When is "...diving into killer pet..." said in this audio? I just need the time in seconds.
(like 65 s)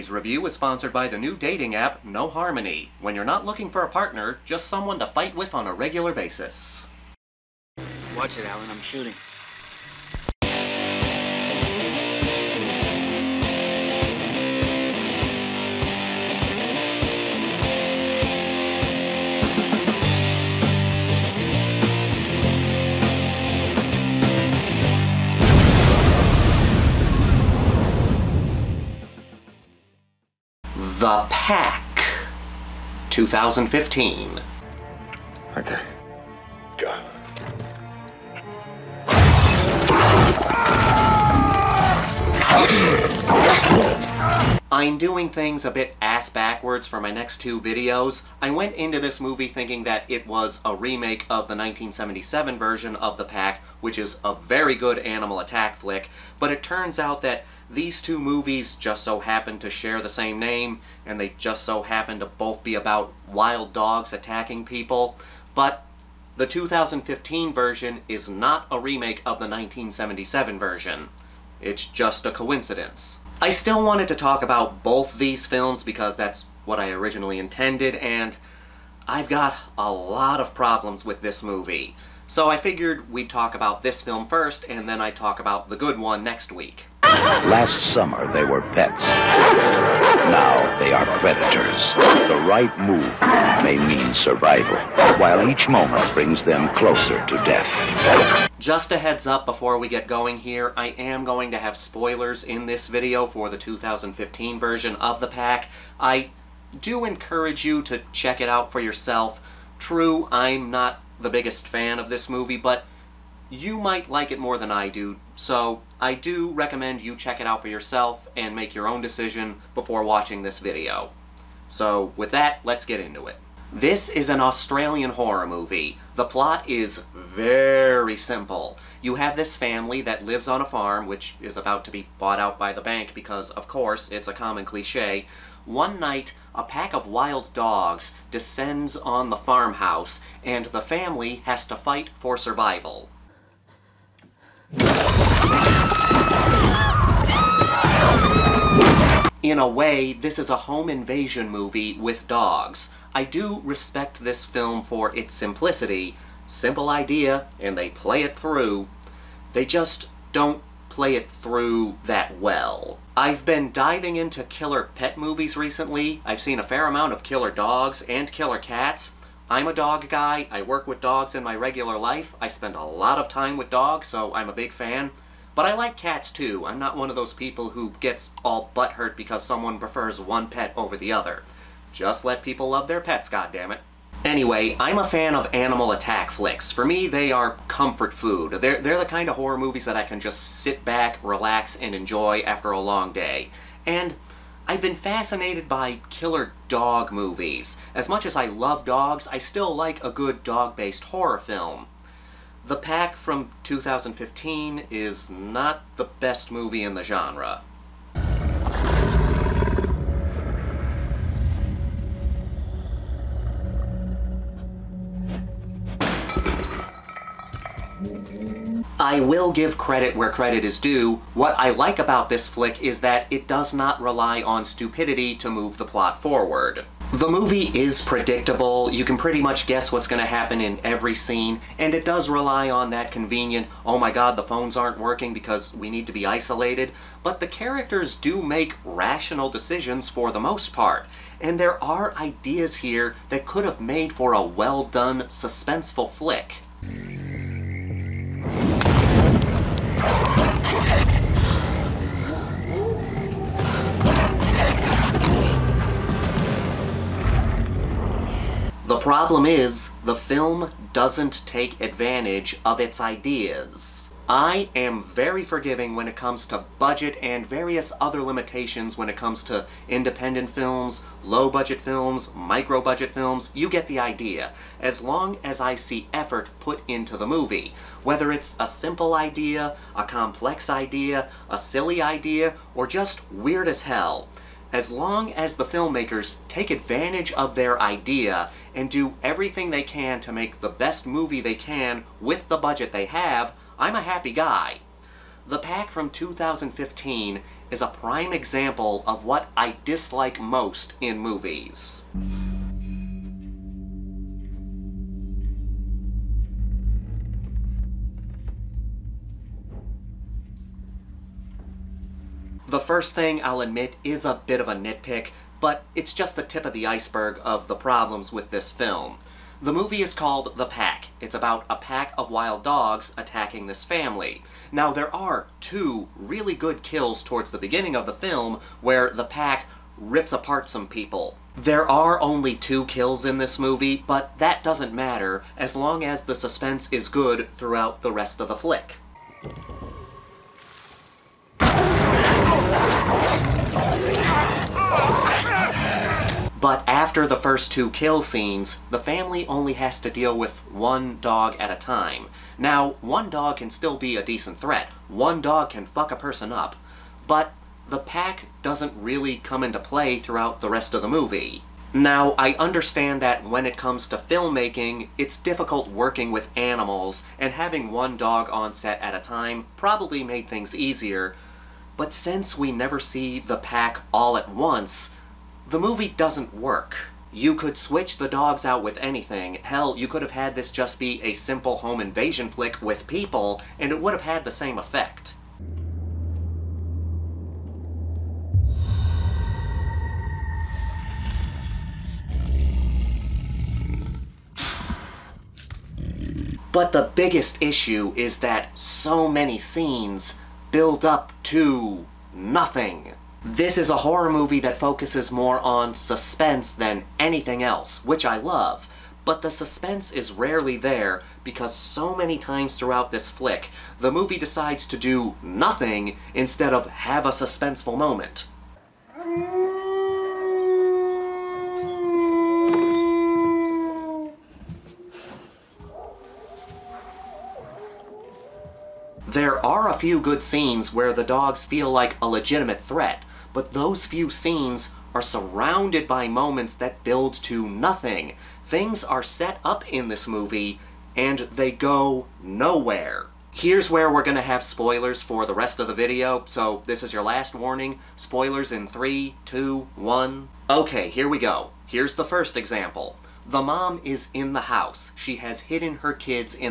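163 s.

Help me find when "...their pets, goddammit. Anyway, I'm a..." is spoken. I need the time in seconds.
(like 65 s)
182 s.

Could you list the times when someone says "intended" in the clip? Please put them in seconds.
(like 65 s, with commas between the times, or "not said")
77 s.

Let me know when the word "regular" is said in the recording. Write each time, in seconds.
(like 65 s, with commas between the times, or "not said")
5 s, 171 s.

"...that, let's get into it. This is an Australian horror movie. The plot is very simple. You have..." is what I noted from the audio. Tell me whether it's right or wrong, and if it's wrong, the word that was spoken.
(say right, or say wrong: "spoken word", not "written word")
right.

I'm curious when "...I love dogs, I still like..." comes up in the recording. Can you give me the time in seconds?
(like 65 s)
198 s.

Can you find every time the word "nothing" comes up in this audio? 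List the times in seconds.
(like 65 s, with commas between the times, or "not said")
402 s, 415 s, 437 s.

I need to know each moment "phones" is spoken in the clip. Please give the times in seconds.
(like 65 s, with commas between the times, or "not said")
234 s.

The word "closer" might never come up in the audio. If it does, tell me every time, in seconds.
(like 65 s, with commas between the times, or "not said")
96 s.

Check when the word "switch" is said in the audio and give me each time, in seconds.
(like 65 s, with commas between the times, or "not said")
377 s.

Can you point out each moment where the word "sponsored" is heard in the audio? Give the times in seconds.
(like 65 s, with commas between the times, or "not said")
0 s.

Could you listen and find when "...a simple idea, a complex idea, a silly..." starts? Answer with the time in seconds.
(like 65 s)
278 s.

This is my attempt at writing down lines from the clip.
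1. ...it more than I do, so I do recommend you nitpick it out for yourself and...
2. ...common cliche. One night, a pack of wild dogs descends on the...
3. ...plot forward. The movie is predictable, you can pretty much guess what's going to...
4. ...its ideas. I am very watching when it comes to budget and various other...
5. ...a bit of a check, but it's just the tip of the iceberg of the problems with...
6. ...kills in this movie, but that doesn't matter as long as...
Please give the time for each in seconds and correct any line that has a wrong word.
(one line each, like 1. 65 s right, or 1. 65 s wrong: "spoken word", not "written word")
1. 114 s wrong: "check", not "nitpick"
2. 134 s right
3. 225 s right
4. 262 s wrong: "forgiving", not "watching"
5. 314 s wrong: "nitpick", not "check"
6. 332 s right.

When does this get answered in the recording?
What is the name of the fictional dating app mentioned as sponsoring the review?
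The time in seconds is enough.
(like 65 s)
2 s.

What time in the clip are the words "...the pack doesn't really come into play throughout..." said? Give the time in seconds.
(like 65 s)
357 s.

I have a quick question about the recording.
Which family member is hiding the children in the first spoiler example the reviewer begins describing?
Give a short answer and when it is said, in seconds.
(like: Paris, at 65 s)
The mom, at 453 s.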